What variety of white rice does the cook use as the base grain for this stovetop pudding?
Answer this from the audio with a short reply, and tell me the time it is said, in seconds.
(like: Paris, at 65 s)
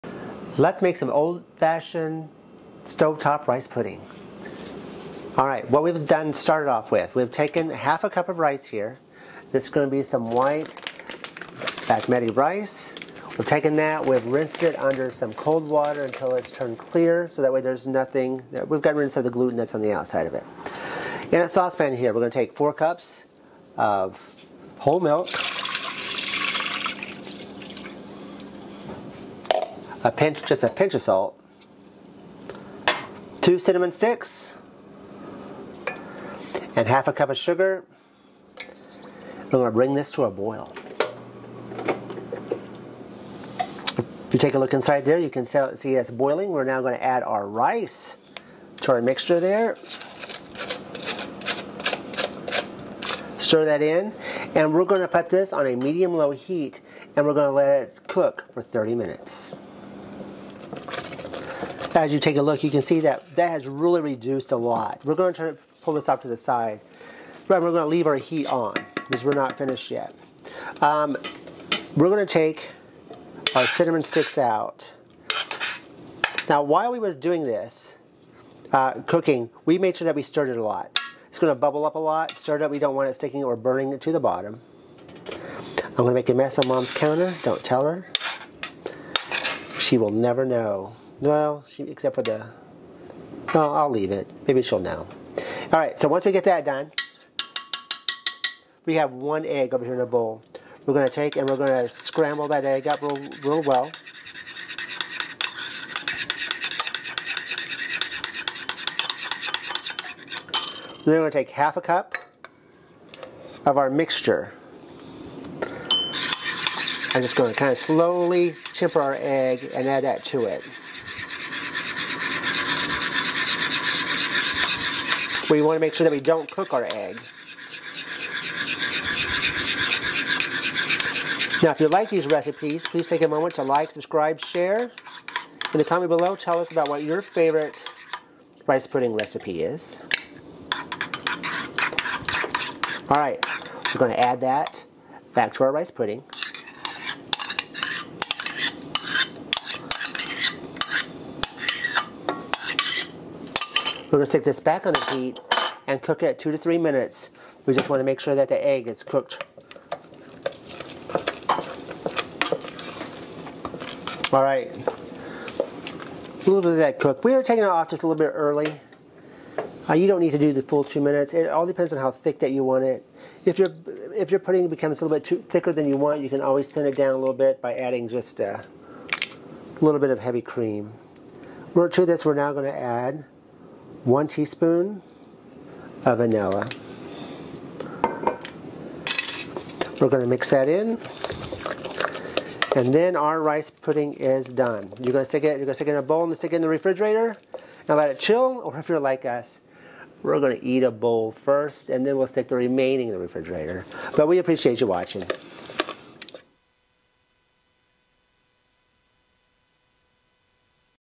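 basmati, at 10 s.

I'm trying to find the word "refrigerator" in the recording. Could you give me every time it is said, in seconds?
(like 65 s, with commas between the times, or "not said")
196 s, 203 s.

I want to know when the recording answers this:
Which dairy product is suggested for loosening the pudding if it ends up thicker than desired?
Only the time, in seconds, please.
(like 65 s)
180 s.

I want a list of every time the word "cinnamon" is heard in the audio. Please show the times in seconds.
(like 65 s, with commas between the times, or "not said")
33 s, 73 s.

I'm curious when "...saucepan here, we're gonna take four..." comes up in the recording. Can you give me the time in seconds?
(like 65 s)
21 s.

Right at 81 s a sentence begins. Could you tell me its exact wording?
It's going to bubble up a lot.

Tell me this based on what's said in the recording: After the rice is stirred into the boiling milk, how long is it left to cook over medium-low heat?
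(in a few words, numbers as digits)
30 minutes.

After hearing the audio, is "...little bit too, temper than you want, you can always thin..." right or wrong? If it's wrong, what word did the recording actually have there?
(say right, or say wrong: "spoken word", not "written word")
wrong: "thicker", not "temper".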